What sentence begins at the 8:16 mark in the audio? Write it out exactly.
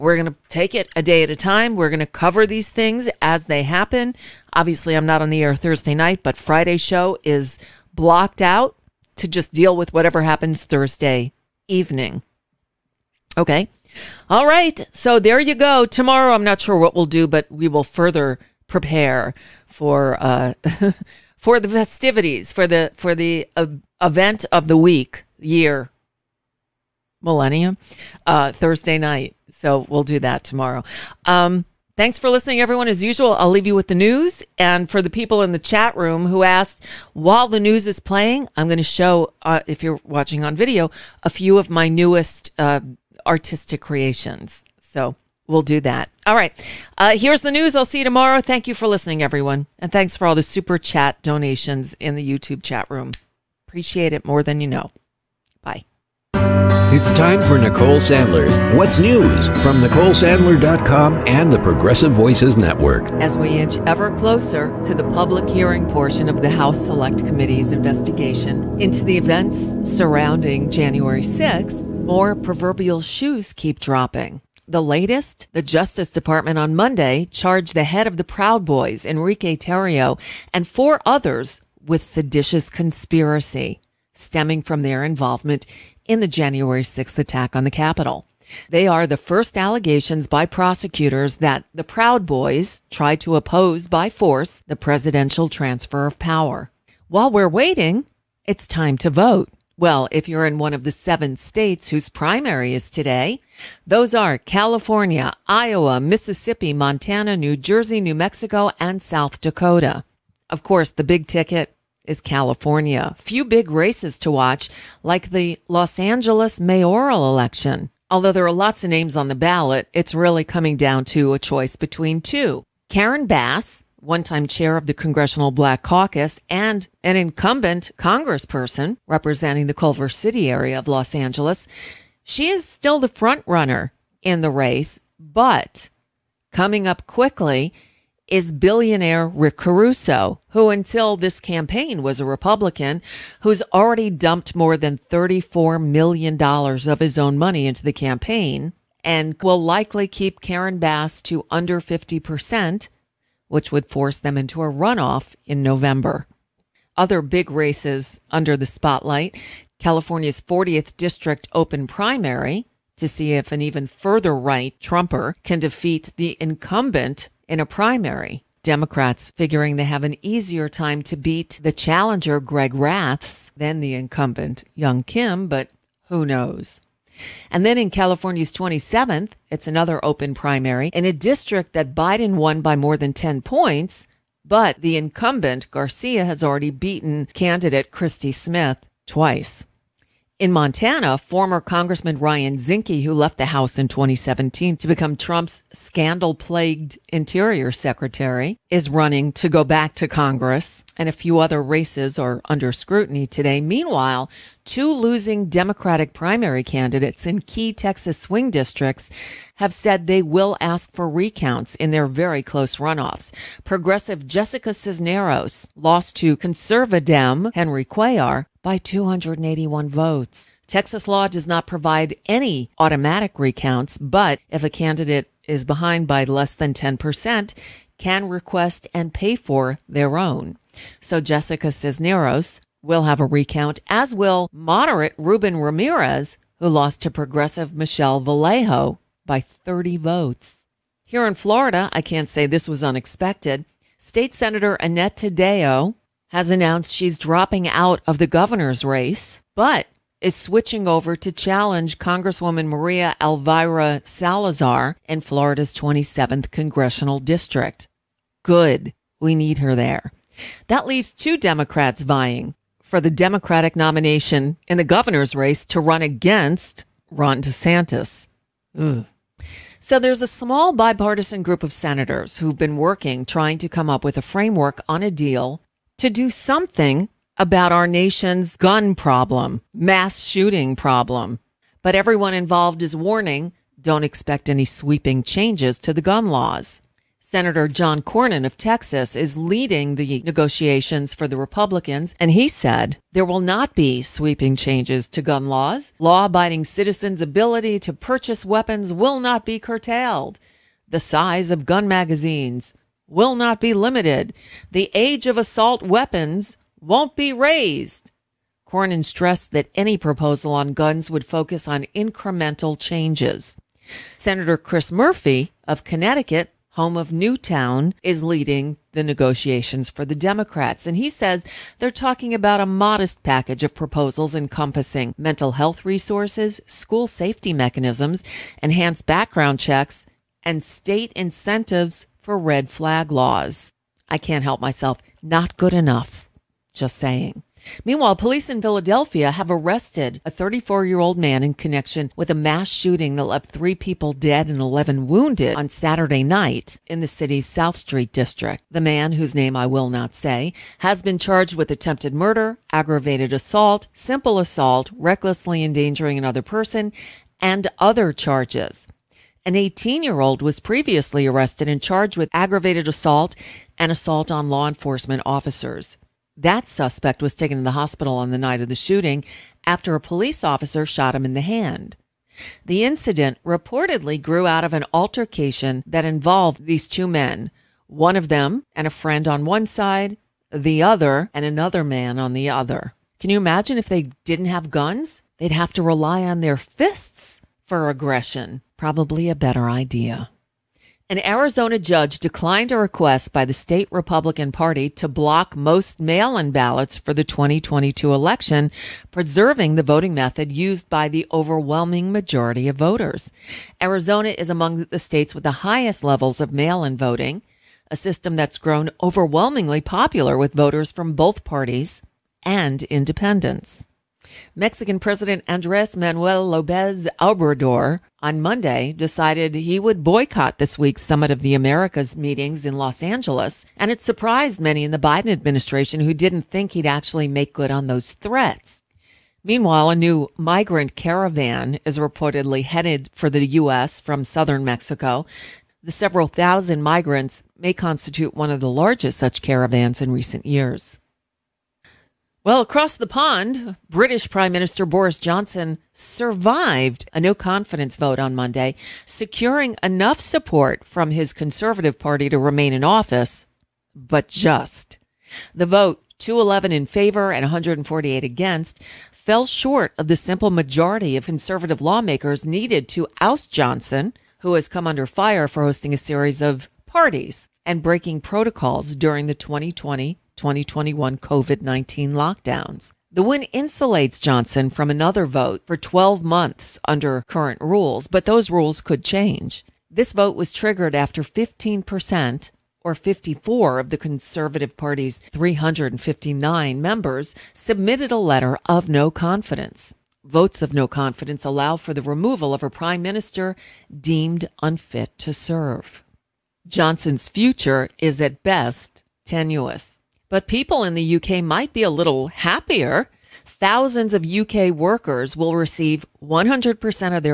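Johnson's future is at best tenuous.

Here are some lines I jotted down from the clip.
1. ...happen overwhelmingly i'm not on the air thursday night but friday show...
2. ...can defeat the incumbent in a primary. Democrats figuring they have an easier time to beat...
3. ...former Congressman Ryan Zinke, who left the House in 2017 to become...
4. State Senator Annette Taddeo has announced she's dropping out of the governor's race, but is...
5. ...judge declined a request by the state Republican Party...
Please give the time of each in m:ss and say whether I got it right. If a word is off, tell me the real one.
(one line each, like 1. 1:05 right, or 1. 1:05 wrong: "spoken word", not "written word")
1. 0:03 wrong: "obviously", not "overwhelmingly"
2. 2:45 right
3. 3:11 right
4. 4:03 right
5. 6:31 right.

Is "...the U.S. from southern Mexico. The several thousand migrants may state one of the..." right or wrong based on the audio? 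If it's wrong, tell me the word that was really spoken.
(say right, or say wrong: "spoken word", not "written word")
wrong: "constitute", not "state".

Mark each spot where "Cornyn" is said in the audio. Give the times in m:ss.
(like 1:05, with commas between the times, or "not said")
4:48, 5:08.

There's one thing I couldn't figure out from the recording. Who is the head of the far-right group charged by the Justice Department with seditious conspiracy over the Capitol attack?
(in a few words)
Enrique Tarrio.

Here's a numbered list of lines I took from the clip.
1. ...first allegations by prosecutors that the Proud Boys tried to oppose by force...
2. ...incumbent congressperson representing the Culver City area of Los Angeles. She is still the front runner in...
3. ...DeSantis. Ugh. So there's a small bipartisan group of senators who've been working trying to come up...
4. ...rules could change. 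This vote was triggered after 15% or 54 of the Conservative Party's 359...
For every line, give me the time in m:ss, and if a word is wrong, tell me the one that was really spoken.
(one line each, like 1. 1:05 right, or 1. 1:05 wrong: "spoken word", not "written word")
1. 1:29 right
2. 2:07 right
3. 4:27 right
4. 7:58 right.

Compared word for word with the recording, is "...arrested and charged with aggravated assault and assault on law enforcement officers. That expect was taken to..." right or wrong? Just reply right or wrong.
wrong.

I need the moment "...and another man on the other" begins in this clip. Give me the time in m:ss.
6:21.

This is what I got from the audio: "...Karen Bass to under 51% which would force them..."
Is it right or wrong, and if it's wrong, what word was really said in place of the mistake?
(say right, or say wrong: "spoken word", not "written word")
wrong: "50", not "51".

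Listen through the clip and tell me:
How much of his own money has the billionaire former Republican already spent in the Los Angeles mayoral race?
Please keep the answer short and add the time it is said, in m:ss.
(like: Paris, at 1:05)
$34 million, at 2:24.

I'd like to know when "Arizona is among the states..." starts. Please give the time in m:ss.
6:43.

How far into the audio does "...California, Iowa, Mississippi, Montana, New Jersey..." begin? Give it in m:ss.
1:44.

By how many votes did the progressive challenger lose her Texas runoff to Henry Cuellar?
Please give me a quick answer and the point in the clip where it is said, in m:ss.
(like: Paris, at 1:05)
281, at 3:38.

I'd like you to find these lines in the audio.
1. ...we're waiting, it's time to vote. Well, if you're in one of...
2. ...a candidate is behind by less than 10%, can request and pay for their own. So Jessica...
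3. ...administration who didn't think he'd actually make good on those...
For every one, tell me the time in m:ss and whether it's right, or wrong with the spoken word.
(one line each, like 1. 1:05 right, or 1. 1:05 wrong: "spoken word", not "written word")
1. 1:37 right
2. 3:44 right
3. 7:05 right.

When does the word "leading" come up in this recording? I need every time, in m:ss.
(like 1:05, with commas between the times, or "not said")
4:49, 5:18.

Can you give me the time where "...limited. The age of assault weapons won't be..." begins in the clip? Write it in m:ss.
5:03.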